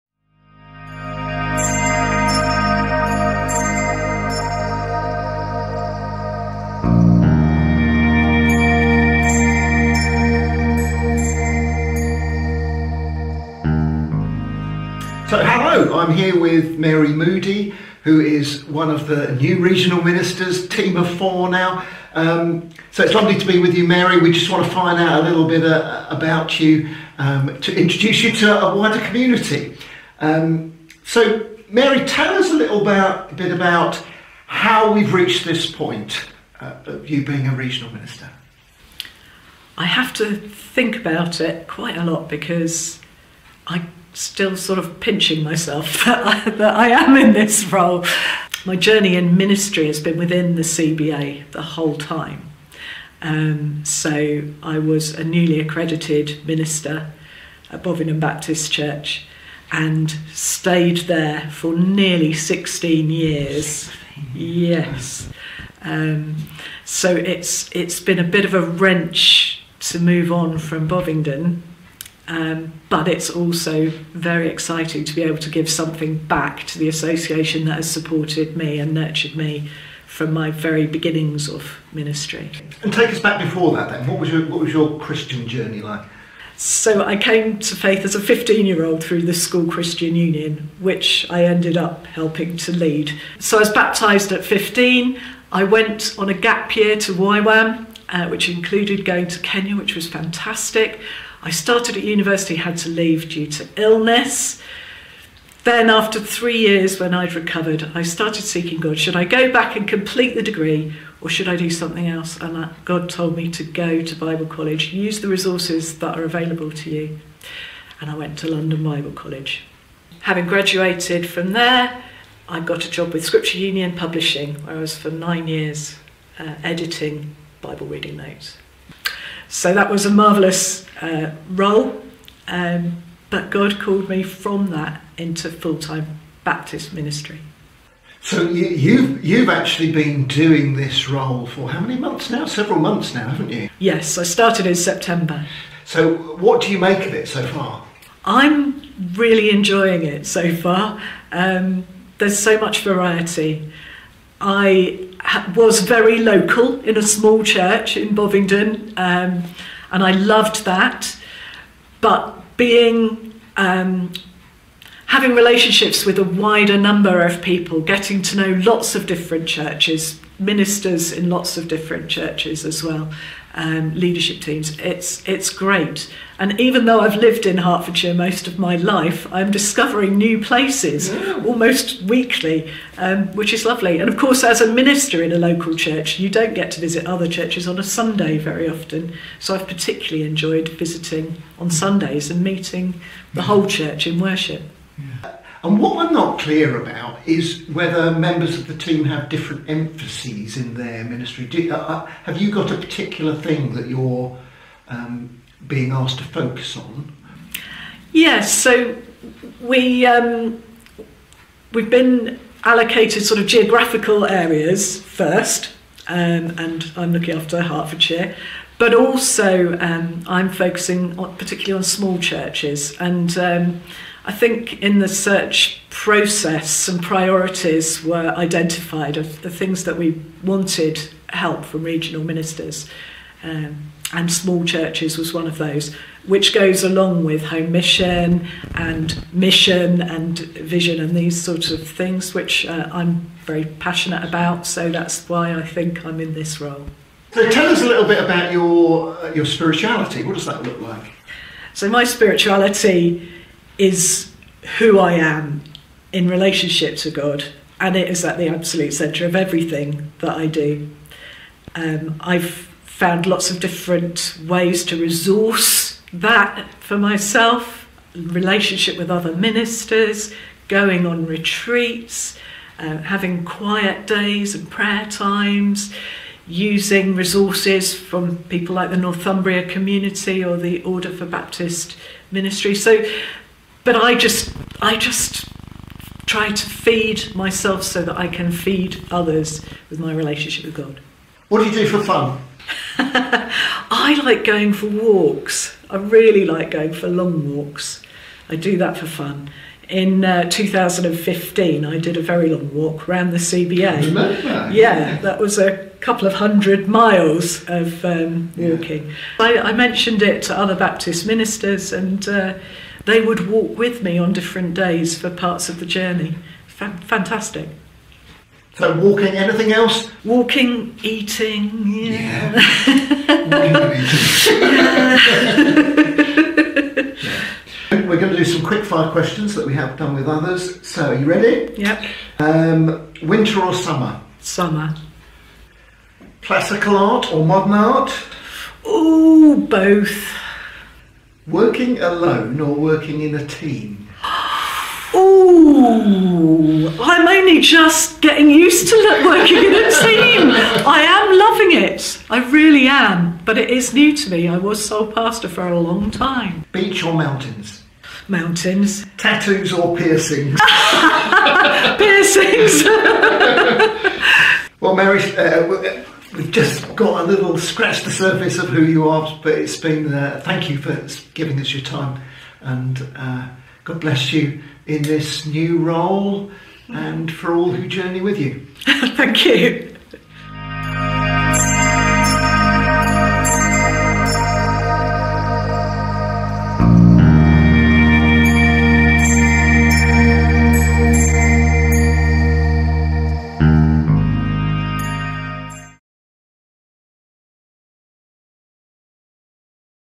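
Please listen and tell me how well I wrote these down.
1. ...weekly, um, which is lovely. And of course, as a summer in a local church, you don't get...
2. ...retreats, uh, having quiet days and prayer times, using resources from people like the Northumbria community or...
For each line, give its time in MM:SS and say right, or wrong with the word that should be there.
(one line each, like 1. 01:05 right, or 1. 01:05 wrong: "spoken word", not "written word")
1. 03:02 wrong: "minister", not "summer"
2. 04:31 right.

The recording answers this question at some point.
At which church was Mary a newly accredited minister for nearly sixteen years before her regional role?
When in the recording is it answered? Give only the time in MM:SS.
00:57.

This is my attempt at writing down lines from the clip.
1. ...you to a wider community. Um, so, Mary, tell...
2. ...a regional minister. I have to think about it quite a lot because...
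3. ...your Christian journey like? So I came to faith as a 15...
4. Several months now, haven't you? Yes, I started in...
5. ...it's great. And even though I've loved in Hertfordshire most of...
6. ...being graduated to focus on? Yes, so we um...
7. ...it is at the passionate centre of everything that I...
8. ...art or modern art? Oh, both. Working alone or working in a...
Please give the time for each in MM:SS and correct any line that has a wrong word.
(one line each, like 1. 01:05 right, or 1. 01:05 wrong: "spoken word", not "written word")
1. 00:28 right
2. 00:37 right
3. 01:24 right
4. 02:22 right
5. 02:55 wrong: "lived", not "loved"
6. 03:25 wrong: "asked", not "graduated"
7. 04:17 wrong: "absolute", not "passionate"
8. 05:36 right.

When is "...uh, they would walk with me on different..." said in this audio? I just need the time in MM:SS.
05:12.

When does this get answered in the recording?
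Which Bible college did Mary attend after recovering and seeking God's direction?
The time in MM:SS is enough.
01:58.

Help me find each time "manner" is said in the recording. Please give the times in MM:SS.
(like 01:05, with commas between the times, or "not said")
not said.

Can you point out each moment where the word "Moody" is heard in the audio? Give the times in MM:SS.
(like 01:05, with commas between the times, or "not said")
00:17.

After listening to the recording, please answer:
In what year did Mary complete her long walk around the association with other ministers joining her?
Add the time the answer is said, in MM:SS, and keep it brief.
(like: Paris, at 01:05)
2015, at 05:00.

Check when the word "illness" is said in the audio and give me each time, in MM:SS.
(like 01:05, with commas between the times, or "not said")
01:43.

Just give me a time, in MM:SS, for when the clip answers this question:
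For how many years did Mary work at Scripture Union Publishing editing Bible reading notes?
02:05.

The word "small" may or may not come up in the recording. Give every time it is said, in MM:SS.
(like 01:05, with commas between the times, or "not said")
02:37, 03:41, 03:54.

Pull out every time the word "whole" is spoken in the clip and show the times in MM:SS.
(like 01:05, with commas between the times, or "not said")
00:51, 03:13.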